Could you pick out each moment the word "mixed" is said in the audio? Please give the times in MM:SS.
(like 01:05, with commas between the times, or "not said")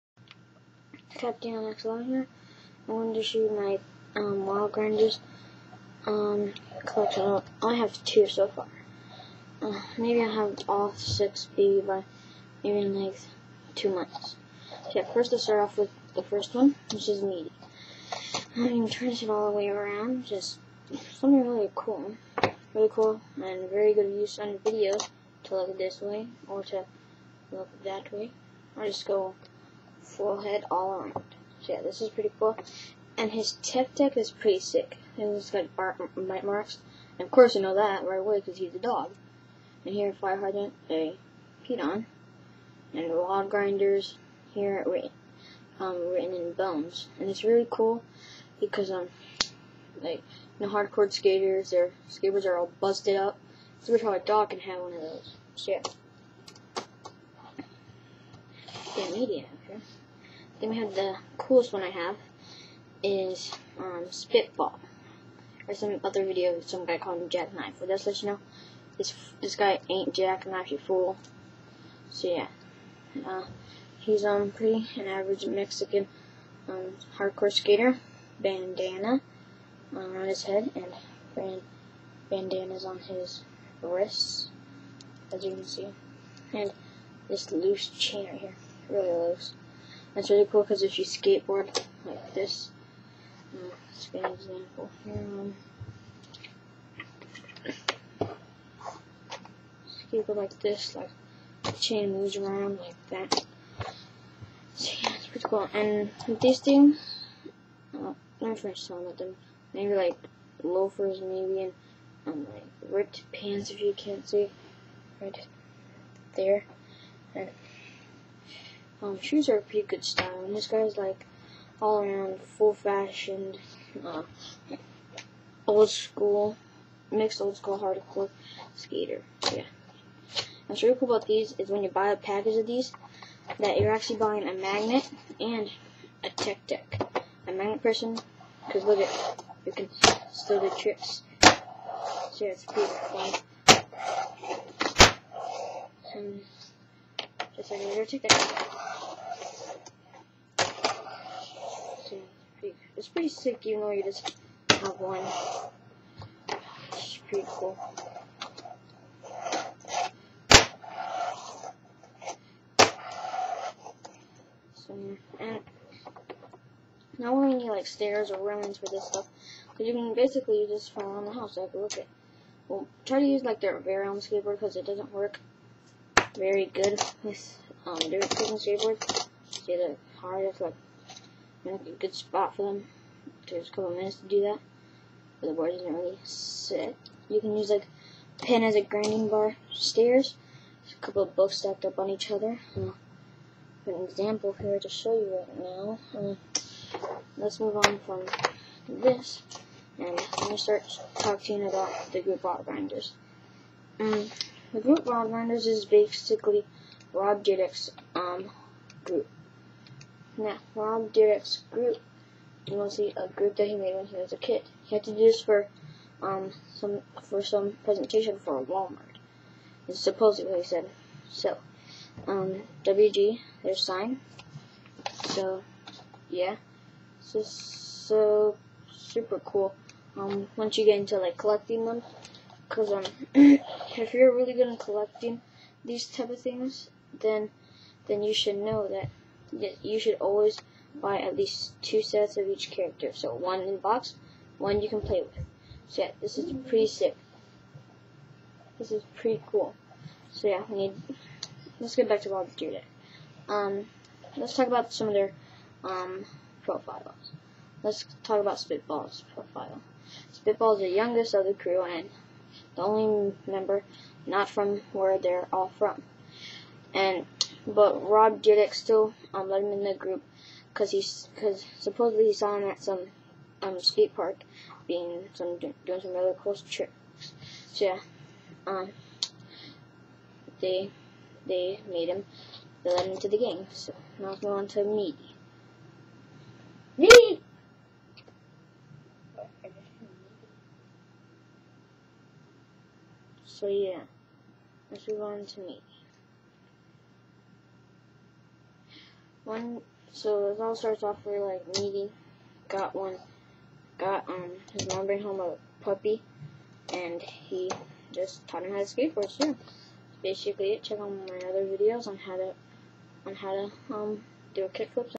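02:07.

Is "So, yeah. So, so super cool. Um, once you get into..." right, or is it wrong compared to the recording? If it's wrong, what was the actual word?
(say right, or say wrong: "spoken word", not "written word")
right.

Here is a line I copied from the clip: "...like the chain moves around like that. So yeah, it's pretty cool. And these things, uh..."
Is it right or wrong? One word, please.
right.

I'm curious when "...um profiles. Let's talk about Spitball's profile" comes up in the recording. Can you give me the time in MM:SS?
04:15.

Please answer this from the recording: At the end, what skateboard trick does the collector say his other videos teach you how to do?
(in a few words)
kickflip.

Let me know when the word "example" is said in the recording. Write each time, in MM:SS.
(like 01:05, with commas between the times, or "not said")
01:34, 03:14.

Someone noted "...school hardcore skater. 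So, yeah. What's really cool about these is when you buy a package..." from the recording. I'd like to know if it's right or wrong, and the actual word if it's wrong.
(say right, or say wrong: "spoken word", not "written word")
right.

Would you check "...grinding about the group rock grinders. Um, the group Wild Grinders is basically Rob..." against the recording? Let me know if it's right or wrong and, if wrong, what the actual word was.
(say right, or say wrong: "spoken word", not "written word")
wrong: "talking", not "grinding".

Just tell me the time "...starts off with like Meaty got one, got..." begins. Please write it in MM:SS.
05:00.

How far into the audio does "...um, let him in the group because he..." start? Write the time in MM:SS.
04:29.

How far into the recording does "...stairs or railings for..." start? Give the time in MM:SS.
02:47.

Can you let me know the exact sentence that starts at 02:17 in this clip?
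A magnet person, because look at, you can still do tricks.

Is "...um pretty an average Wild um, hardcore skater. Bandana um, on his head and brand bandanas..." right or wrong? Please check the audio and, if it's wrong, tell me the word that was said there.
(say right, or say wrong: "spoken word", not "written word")
wrong: "Mexican", not "Wild".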